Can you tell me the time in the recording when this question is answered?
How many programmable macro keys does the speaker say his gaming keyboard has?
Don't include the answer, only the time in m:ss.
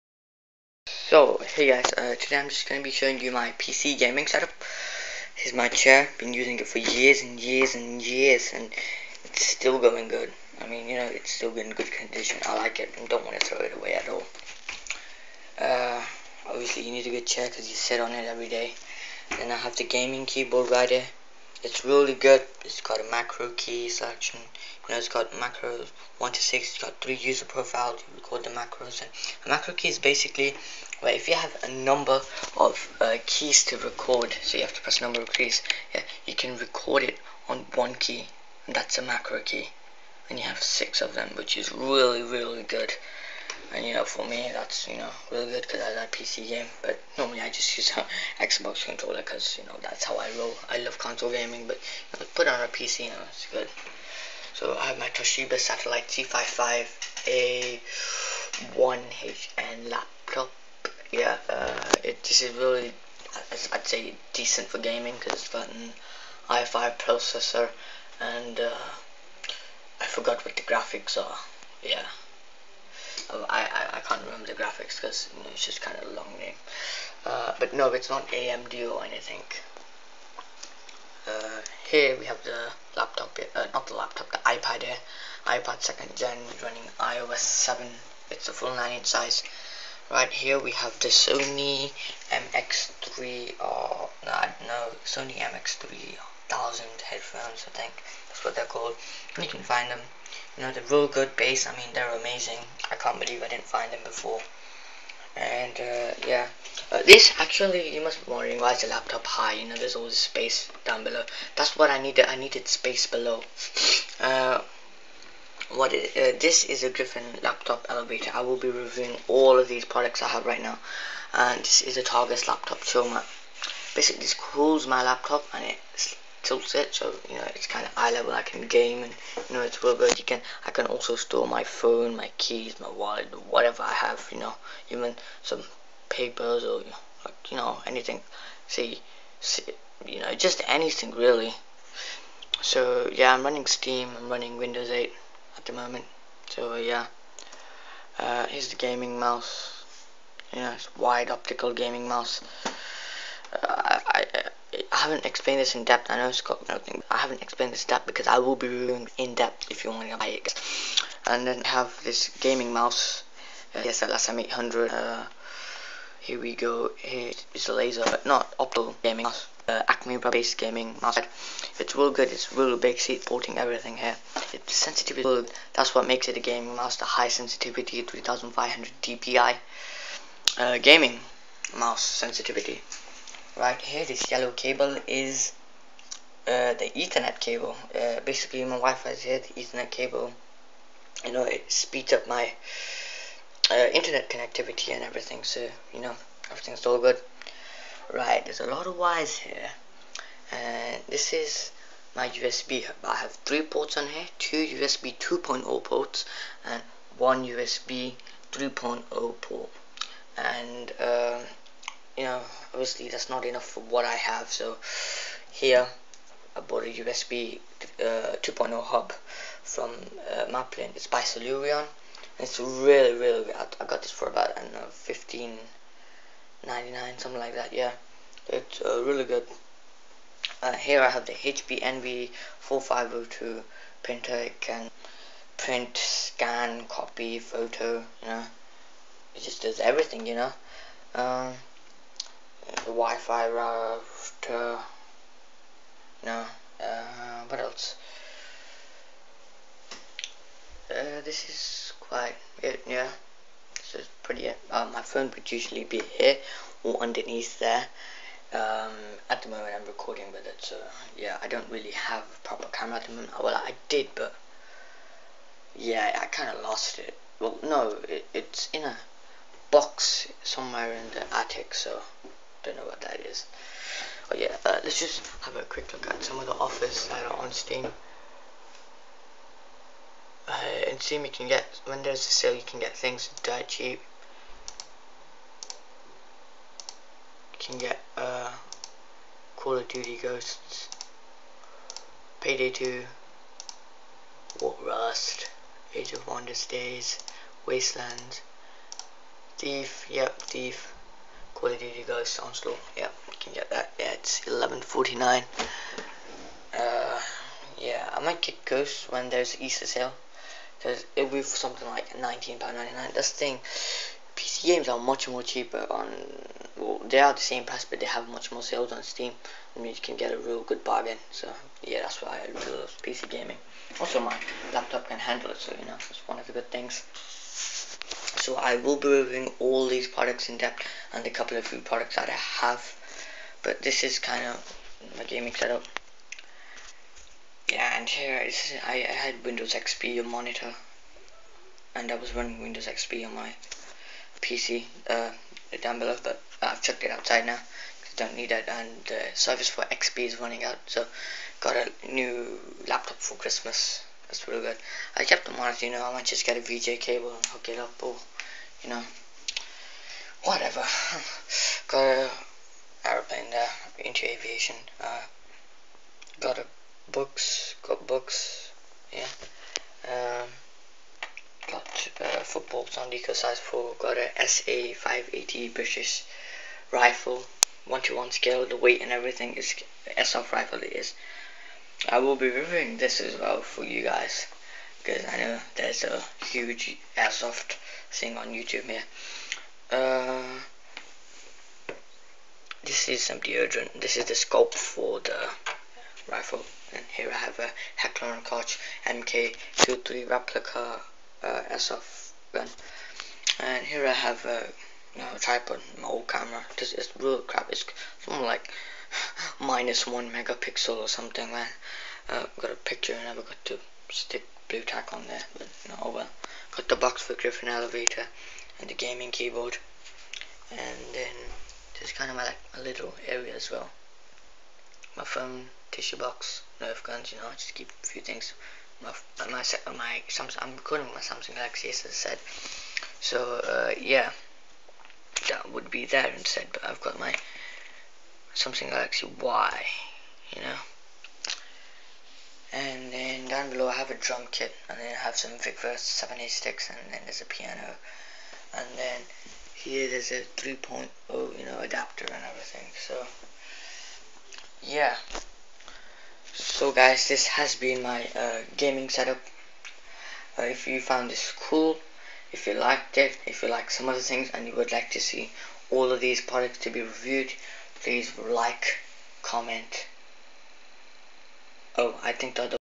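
0:40.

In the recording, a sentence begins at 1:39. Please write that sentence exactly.
you can find them you know, the real good bass, I mean, they're amazing.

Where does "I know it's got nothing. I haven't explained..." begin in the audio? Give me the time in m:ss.
2:36.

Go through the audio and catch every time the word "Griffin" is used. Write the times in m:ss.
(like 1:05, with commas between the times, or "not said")
1:56, 6:57.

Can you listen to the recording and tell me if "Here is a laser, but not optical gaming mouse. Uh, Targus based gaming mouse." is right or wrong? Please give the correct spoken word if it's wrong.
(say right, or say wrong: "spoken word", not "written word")
wrong: "Acme", not "Targus".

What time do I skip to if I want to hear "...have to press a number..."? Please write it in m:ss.
0:34.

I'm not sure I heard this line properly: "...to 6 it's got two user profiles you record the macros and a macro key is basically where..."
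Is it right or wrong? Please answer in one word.
wrong.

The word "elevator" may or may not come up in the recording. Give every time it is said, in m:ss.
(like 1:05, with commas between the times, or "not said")
1:57, 6:57.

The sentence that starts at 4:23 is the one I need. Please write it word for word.
Well, I did, but yeah, I kind of lost it.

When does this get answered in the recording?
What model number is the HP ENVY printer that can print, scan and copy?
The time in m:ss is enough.
3:52.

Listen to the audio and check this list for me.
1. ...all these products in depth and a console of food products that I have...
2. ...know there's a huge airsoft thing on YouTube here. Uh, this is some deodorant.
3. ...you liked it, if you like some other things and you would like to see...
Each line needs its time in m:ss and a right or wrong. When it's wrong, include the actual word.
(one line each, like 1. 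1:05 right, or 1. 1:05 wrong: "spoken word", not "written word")
1. 5:29 wrong: "couple", not "console"
2. 6:25 right
3. 7:42 right.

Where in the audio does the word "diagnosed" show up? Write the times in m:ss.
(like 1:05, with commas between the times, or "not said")
not said.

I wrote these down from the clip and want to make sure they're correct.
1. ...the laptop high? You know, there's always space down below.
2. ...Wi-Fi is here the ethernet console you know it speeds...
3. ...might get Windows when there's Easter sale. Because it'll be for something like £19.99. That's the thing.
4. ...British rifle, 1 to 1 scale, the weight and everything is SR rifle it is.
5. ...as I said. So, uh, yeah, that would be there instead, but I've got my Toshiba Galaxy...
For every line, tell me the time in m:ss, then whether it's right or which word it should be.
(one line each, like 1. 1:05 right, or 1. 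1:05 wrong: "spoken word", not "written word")
1. 1:48 right
2. 3:08 wrong: "cable", not "console"
3. 5:08 wrong: "Ghost", not "Windows"
4. 6:15 right
5. 7:11 wrong: "Samsung", not "Toshiba".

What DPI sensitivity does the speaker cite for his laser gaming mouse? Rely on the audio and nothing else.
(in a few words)
3500.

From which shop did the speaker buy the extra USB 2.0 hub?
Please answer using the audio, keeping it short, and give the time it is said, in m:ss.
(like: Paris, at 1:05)
Maplin, at 3:40.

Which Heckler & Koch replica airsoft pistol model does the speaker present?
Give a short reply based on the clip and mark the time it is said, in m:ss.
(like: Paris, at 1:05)
MK23, at 6:39.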